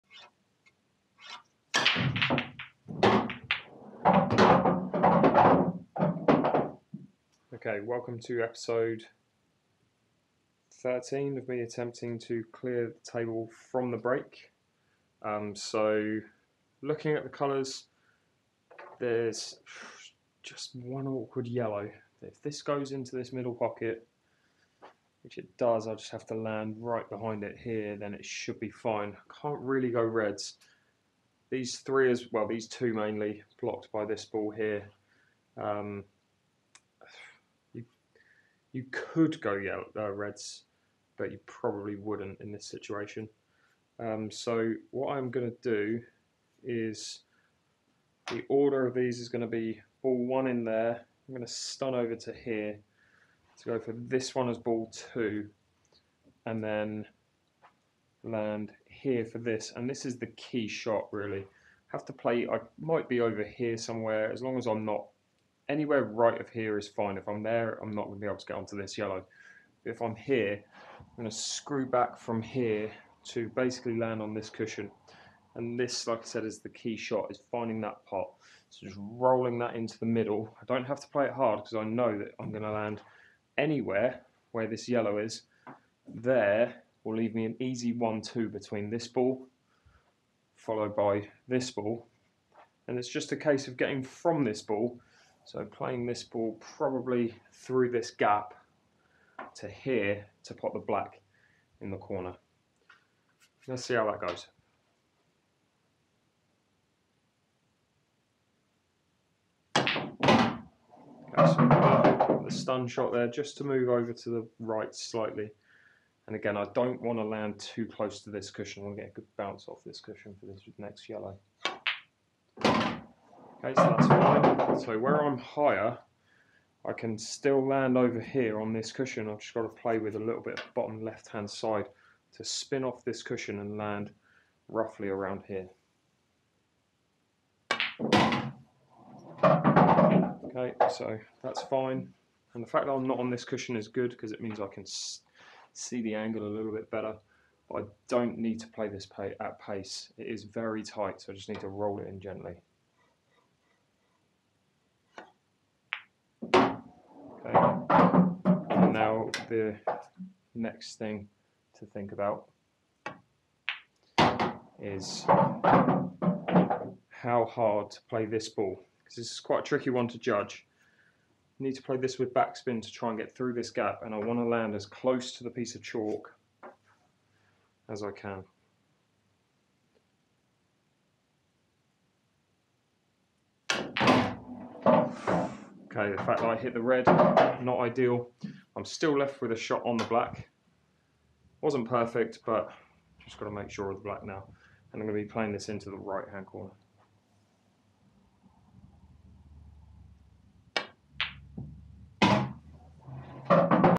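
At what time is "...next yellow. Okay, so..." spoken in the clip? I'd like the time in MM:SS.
02:00.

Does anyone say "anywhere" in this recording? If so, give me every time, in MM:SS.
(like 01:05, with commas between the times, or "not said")
01:05, 01:23.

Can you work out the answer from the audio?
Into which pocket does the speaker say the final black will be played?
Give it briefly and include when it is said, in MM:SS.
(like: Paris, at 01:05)
right hand corner, at 03:15.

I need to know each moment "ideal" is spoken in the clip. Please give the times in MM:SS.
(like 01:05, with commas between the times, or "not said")
03:07.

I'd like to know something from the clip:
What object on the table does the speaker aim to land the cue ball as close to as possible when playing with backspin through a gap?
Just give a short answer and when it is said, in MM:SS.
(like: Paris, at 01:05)
piece of chalk, at 02:55.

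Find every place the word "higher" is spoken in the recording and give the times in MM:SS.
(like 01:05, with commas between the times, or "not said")
02:05.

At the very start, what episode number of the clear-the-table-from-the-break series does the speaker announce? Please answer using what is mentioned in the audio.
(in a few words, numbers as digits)
13.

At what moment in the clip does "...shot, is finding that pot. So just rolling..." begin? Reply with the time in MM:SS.
01:16.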